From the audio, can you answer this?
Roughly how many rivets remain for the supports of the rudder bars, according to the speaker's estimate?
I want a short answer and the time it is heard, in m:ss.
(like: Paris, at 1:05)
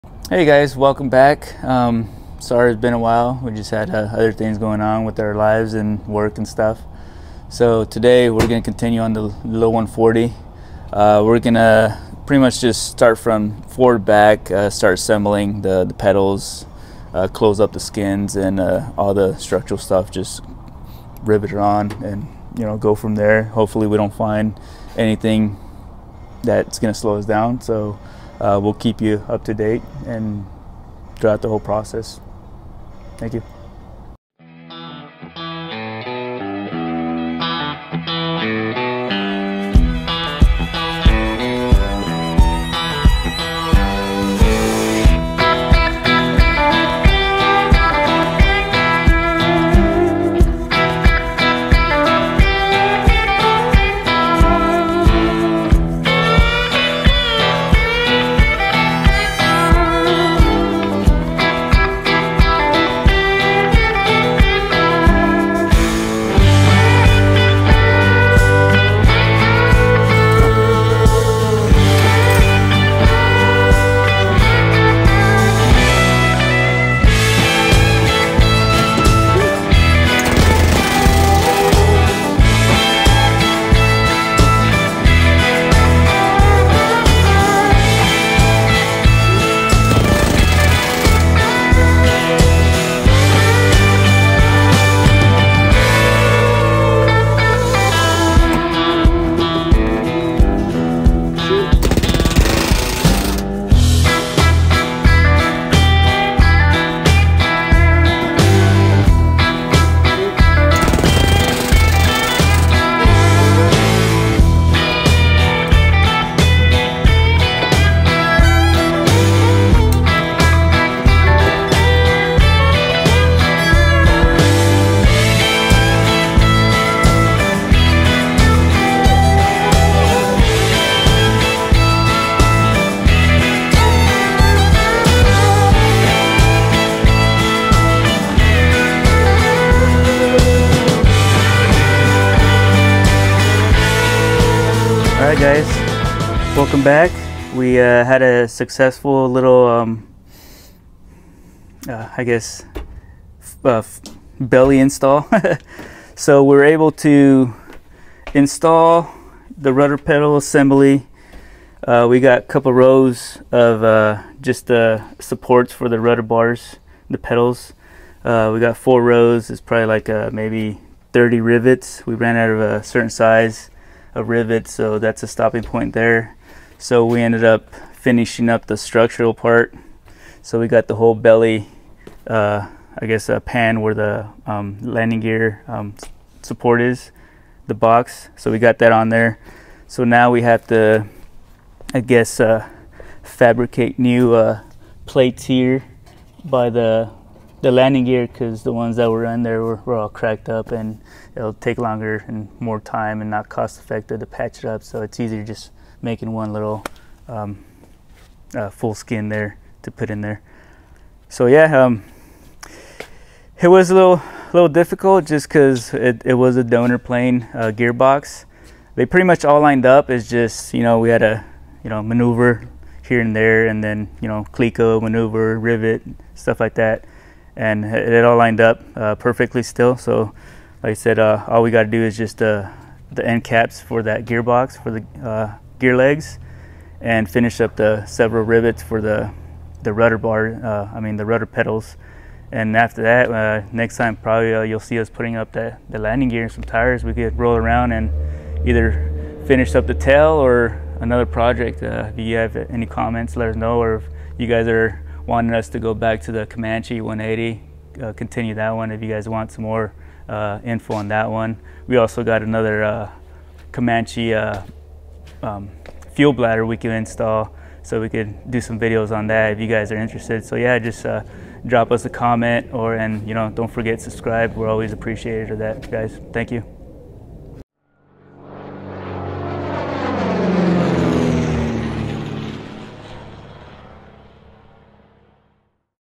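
30, at 2:51.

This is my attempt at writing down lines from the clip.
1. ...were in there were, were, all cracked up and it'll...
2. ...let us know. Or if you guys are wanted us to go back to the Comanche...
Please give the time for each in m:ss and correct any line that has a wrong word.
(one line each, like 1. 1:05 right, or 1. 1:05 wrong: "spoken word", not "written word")
1. 3:19 right
2. 4:13 right.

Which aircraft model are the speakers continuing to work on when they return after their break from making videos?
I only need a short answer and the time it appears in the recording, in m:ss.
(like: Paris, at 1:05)
140, at 0:09.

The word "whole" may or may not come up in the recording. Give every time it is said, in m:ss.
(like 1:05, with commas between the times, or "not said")
0:31, 3:00.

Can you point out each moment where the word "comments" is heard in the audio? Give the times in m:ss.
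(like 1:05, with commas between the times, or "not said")
4:12, 4:32.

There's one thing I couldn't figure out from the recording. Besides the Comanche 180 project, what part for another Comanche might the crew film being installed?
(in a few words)
fuel bladder.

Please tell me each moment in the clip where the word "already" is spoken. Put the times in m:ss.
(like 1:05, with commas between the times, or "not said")
not said.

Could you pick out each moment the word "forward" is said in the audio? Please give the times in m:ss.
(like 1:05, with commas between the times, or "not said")
0:13.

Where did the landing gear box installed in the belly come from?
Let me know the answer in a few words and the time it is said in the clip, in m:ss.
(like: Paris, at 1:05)
a donor plane, at 3:36.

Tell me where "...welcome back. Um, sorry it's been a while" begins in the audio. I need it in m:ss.
0:00.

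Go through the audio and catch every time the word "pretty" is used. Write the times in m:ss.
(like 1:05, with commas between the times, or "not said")
0:12, 3:39.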